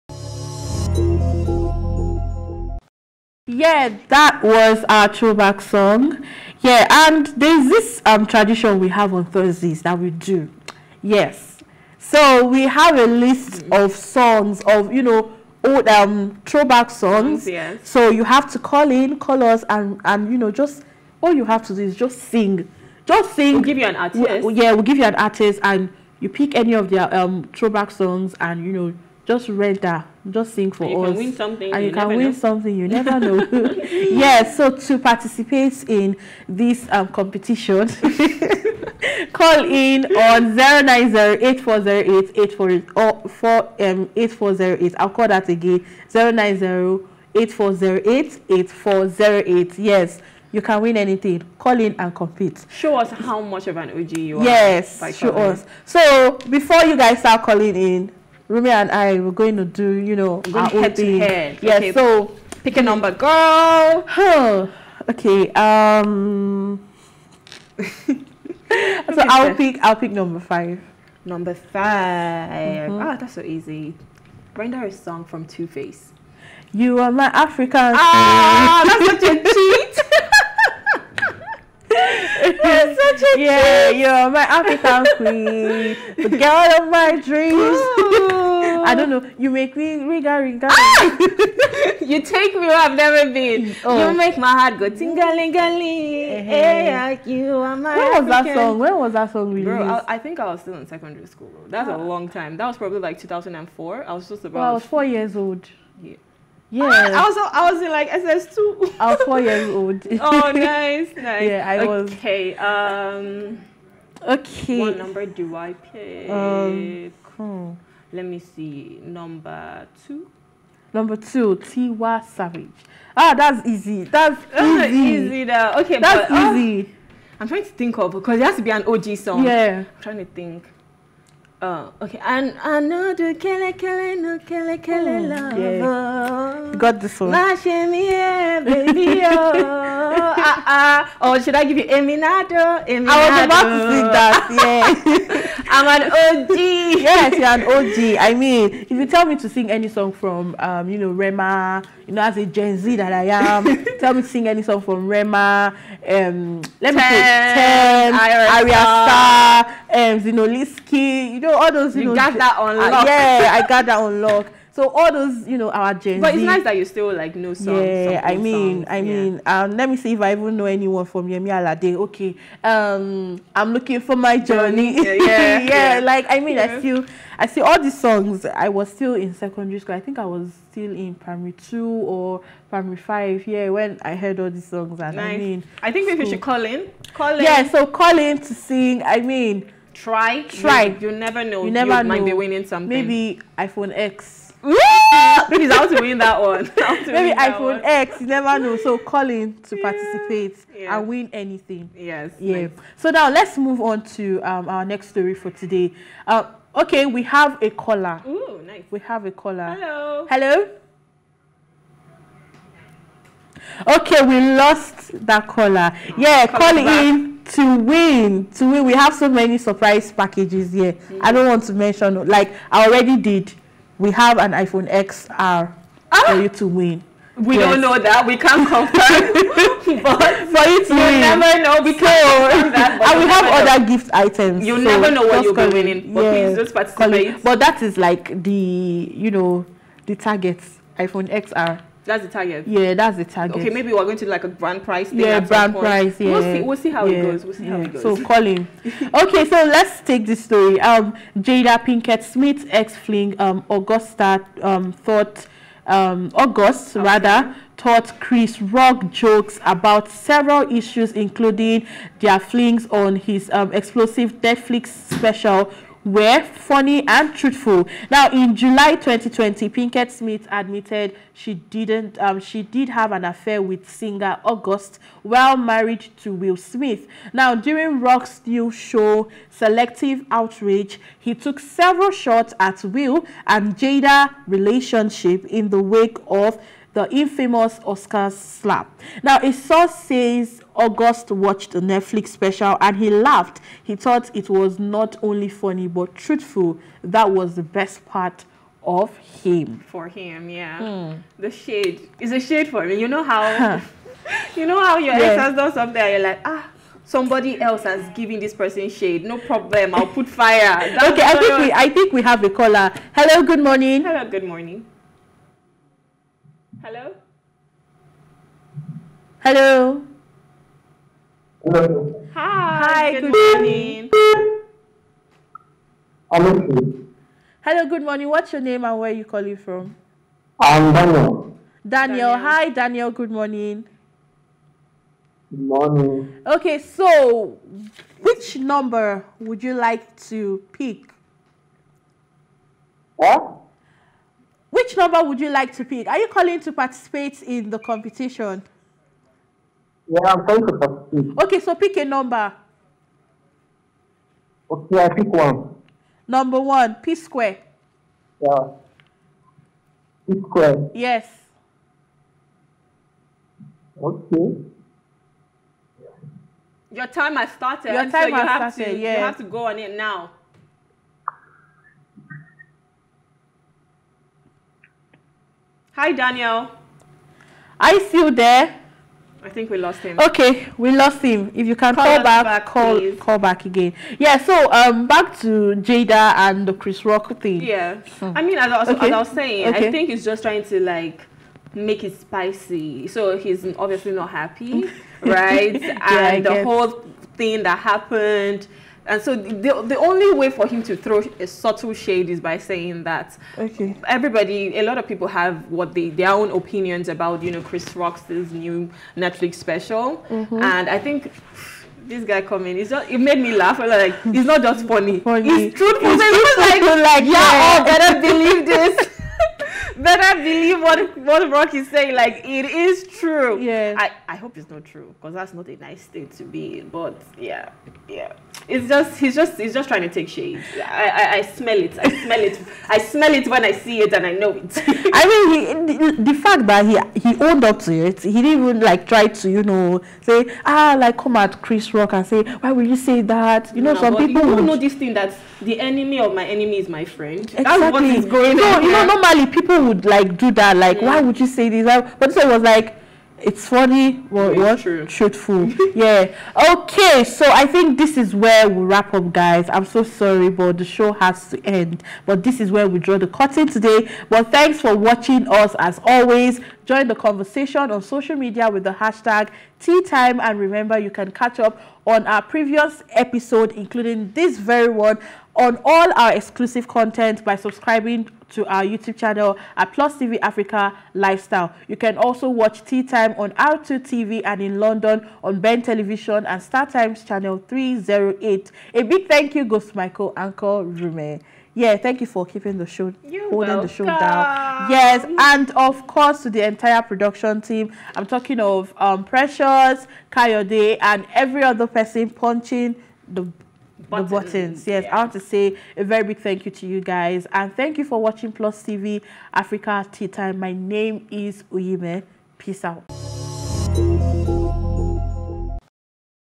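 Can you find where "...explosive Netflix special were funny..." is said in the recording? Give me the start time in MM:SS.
04:23.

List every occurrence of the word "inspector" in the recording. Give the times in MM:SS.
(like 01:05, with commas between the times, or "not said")
not said.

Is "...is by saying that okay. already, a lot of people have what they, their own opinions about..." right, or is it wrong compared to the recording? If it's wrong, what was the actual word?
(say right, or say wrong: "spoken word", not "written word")
wrong: "everybody", not "already".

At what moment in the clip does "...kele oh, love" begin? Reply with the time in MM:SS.
02:14.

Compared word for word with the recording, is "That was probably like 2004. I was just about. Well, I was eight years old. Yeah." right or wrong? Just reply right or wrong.
wrong.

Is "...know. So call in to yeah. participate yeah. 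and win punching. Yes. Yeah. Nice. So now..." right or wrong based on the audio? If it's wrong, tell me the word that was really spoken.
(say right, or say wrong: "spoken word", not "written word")
wrong: "anything", not "punching".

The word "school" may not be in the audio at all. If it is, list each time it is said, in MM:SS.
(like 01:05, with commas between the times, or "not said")
01:41, 02:59.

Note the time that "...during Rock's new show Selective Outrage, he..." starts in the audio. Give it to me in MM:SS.
04:37.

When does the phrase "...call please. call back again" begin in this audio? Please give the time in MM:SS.
06:22.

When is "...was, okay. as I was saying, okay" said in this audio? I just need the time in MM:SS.
06:28.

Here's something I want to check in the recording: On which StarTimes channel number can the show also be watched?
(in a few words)
308.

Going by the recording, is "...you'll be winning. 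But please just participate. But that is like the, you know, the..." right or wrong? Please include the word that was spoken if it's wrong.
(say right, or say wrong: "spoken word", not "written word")
right.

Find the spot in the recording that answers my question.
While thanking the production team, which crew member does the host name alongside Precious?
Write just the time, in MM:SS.
08:20.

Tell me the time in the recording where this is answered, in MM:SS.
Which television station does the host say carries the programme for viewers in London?
08:05.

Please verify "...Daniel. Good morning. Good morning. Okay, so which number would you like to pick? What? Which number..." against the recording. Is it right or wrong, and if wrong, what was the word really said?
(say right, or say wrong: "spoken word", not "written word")
right.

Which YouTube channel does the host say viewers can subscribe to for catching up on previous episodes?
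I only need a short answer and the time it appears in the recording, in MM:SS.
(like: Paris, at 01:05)
Plus TV Africa Lifestyle, at 07:59.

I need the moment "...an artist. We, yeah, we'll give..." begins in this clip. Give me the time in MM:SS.
00:23.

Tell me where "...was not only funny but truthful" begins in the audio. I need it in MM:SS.
04:54.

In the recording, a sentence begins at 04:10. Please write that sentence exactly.
Um, Jada Pinkett Smith ex fling um Augusta um thought um August okay.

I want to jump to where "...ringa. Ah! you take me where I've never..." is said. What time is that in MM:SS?
01:30.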